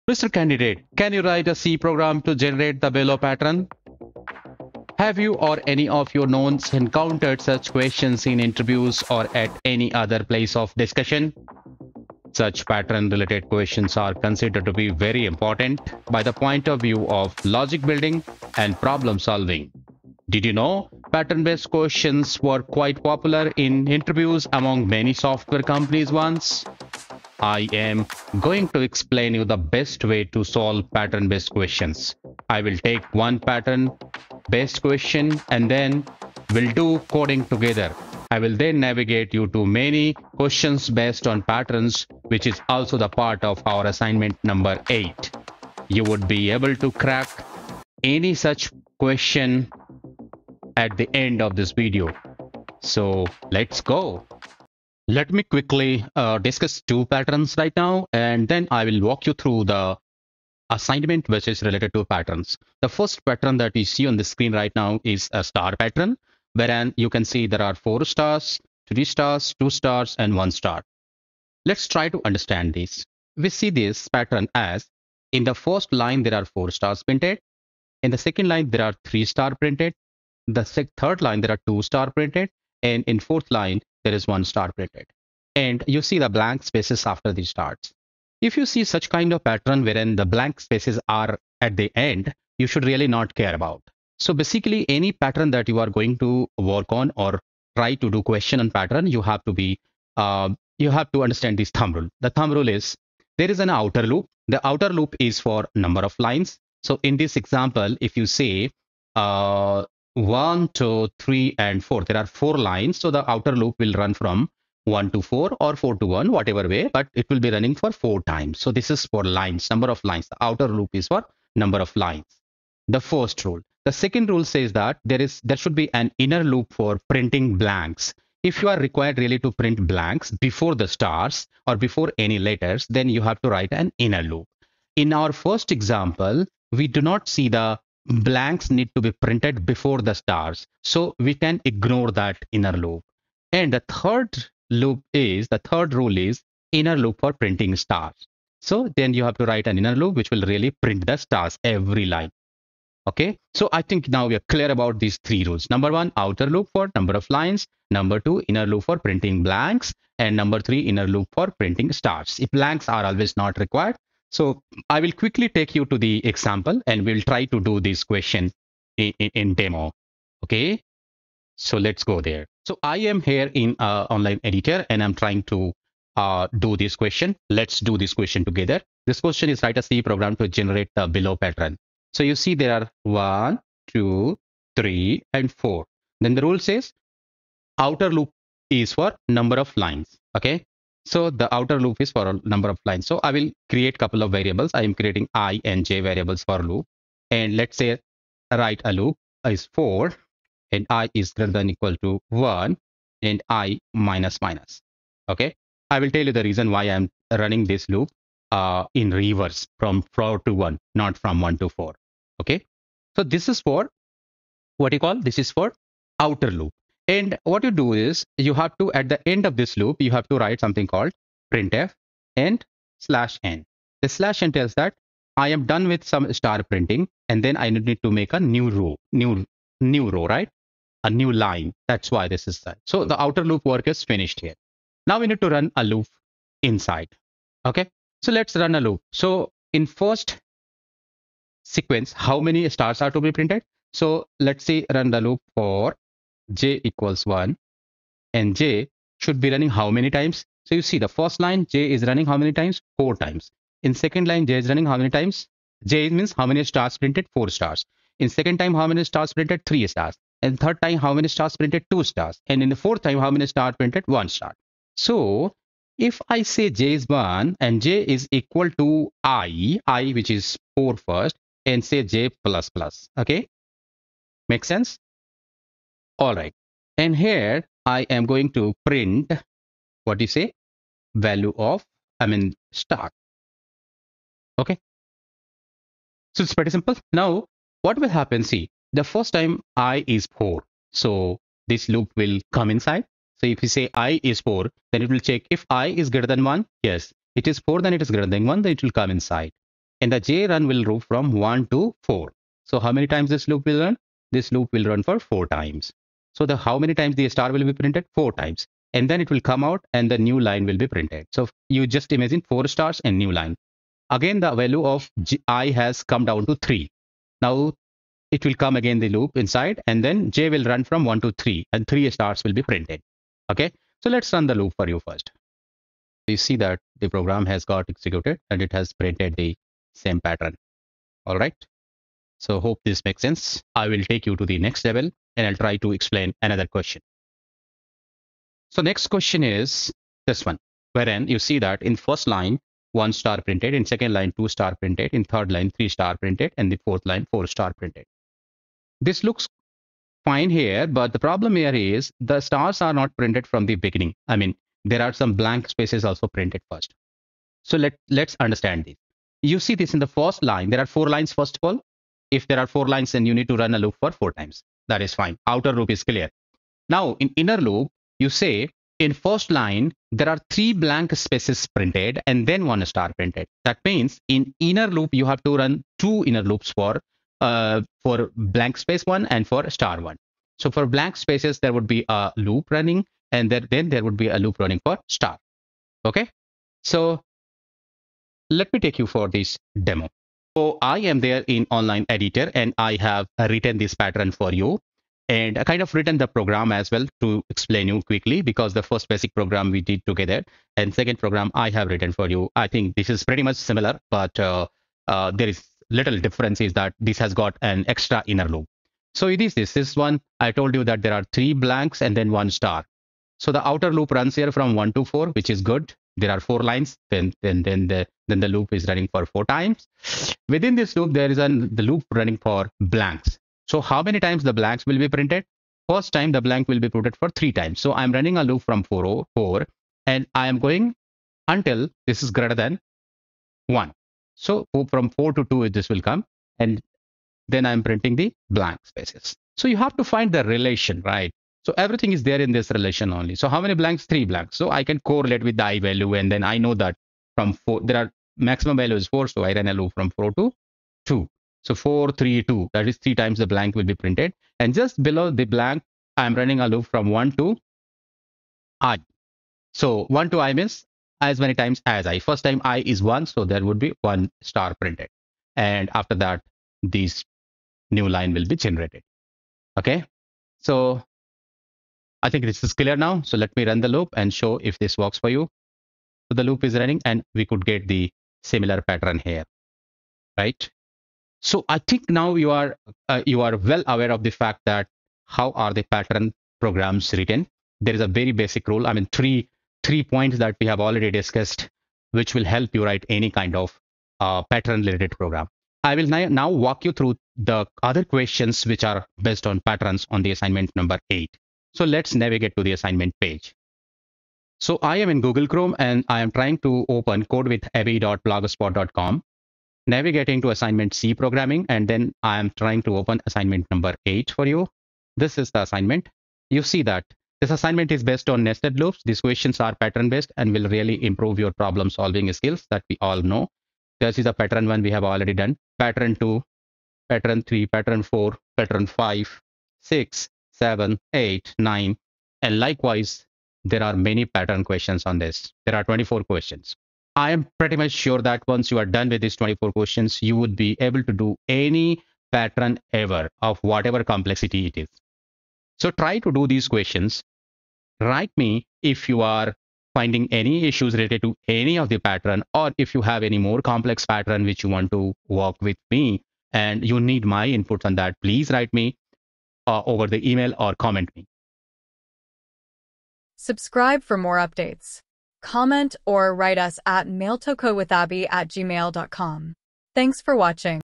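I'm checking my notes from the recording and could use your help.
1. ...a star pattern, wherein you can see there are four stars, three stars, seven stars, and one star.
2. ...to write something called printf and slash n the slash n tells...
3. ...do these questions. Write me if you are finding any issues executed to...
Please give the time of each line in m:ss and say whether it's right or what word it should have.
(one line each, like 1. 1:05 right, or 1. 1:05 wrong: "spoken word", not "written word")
1. 1:05 wrong: "two", not "seven"
2. 3:40 right
3. 9:06 wrong: "related", not "executed".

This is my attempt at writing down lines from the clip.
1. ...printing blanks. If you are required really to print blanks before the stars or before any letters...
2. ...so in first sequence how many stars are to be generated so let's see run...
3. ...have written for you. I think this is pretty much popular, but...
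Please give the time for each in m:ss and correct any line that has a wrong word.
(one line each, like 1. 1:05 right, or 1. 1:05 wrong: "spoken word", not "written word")
1. 2:07 right
2. 3:59 wrong: "printed", not "generated"
3. 6:41 wrong: "similar", not "popular".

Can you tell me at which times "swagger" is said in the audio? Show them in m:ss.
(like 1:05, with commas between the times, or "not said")
not said.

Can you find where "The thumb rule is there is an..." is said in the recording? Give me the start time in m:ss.
1:42.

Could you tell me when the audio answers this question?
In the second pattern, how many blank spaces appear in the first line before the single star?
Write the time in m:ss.
6:10.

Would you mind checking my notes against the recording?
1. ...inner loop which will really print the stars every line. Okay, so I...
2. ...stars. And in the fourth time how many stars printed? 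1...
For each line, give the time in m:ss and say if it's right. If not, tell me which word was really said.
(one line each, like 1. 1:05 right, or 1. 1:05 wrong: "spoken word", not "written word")
1. 2:29 right
2. 4:22 right.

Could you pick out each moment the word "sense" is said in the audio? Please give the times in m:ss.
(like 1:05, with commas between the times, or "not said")
4:34, 5:33.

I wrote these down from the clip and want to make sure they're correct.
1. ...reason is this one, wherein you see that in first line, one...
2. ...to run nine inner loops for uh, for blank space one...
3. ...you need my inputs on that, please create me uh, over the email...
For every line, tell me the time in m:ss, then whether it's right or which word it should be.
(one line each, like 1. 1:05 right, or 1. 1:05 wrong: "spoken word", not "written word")
1. 5:39 wrong: "question", not "reason"
2. 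6:15 wrong: "two", not "nine"
3. 9:16 wrong: "write", not "create".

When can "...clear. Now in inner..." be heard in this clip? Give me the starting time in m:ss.
6:06.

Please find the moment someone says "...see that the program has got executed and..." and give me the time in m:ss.
5:26.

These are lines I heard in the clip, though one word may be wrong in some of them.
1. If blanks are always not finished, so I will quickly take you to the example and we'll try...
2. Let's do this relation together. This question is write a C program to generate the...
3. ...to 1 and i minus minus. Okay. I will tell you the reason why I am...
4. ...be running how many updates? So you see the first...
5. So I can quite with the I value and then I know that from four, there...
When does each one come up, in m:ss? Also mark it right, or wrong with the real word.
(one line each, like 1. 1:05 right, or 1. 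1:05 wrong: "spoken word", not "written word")
1. 2:42 wrong: "required", not "finished"
2. 2:57 wrong: "question", not "relation"
3. 3:22 right
4. 4:09 wrong: "times", not "updates"
5. 7:24 wrong: "correlate", not "quite".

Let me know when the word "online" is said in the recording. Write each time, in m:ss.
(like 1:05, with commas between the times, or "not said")
2:54, 6:31.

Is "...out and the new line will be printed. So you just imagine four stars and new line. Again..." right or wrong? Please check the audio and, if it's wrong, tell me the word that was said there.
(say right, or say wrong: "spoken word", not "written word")
right.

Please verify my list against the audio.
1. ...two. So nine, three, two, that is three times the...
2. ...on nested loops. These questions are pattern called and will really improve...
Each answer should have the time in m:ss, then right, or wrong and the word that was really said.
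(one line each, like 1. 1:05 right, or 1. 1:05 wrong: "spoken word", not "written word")
1. 7:31 wrong: "four", not "nine"
2. 8:38 wrong: "based", not "called".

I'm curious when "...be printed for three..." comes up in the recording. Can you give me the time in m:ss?
7:06.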